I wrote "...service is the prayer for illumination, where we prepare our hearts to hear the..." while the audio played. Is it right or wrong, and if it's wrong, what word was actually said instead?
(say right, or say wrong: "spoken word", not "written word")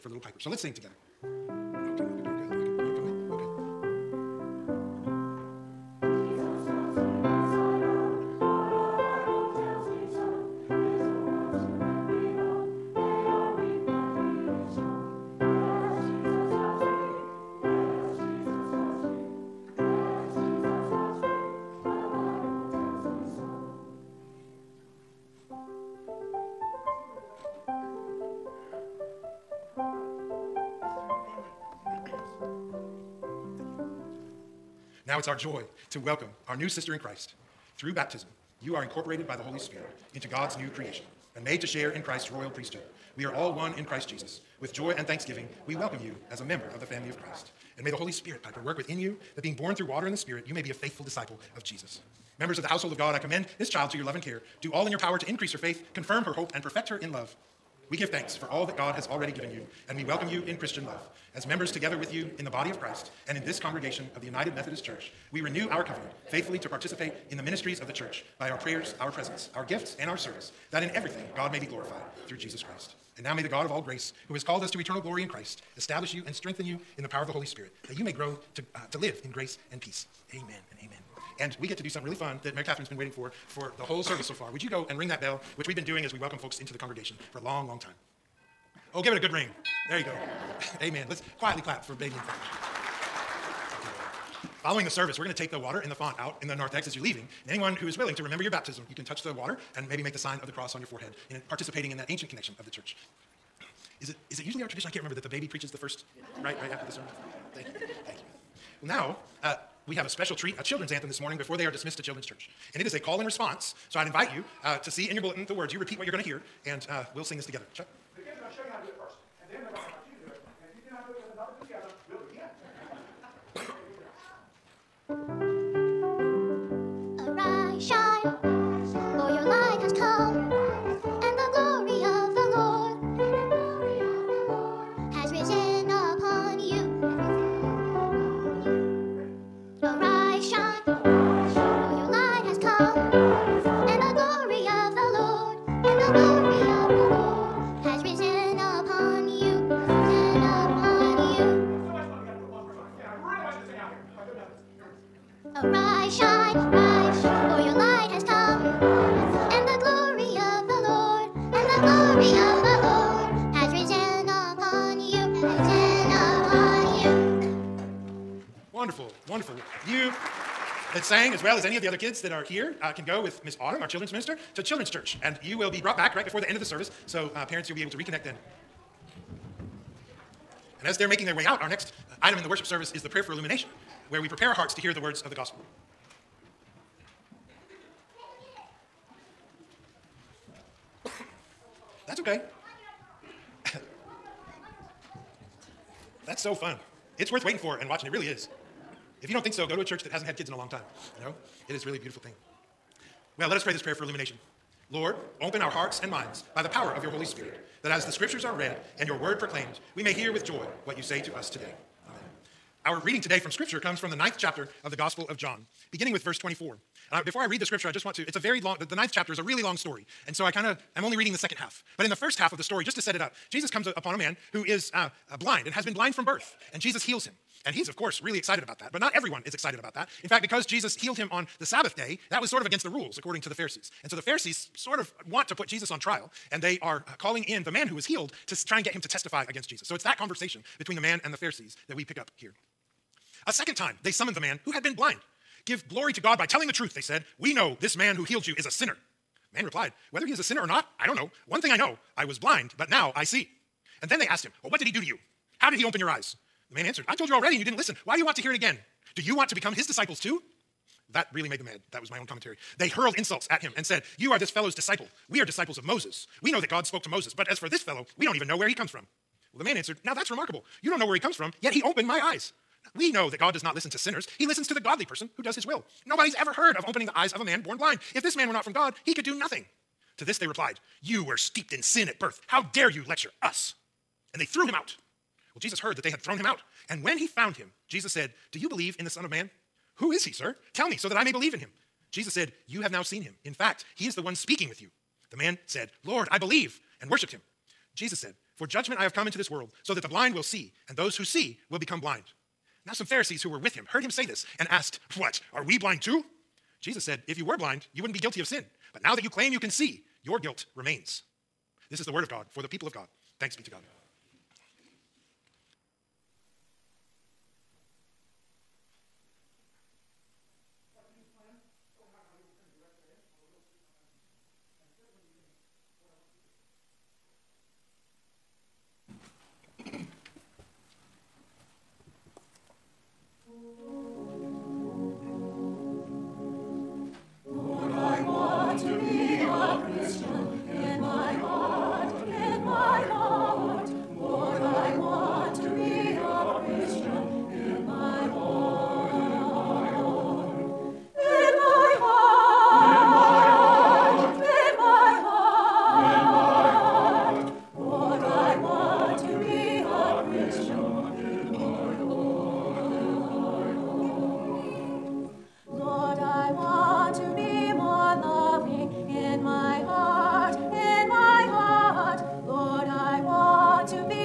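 right.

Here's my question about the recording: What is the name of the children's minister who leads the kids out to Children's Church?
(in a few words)
Miss Autumn.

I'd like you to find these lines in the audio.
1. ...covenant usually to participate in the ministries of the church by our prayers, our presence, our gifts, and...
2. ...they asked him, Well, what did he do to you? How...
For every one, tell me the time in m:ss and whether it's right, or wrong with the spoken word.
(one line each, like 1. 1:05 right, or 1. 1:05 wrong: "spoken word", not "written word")
1. 1:05 wrong: "faithfully", not "usually"
2. 4:14 right.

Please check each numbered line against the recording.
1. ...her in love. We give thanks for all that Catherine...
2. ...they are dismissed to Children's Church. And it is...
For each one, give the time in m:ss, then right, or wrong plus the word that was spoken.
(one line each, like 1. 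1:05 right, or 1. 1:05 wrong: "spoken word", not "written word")
1. 0:56 wrong: "God", not "Catherine"
2. 1:51 right.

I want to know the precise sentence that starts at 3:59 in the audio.
So it's that conversation between the man and the Pharisees that we pick up here.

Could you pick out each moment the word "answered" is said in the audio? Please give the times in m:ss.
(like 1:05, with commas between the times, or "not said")
4:16, 4:29.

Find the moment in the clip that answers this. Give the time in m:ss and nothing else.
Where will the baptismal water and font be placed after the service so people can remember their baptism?
1:36.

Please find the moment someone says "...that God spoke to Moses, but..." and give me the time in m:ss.
4:26.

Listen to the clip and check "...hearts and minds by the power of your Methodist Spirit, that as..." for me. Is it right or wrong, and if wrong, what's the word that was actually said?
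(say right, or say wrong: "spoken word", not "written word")
wrong: "Holy", not "Methodist".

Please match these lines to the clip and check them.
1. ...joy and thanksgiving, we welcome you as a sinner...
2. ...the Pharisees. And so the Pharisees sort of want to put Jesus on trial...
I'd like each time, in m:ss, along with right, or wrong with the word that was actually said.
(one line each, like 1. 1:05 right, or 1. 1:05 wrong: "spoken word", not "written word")
1. 0:44 wrong: "member", not "sinner"
2. 3:53 right.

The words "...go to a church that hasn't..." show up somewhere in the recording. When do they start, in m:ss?
3:19.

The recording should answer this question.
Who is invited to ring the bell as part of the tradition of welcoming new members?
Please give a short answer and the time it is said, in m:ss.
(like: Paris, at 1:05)
Mary Catherine, at 1:22.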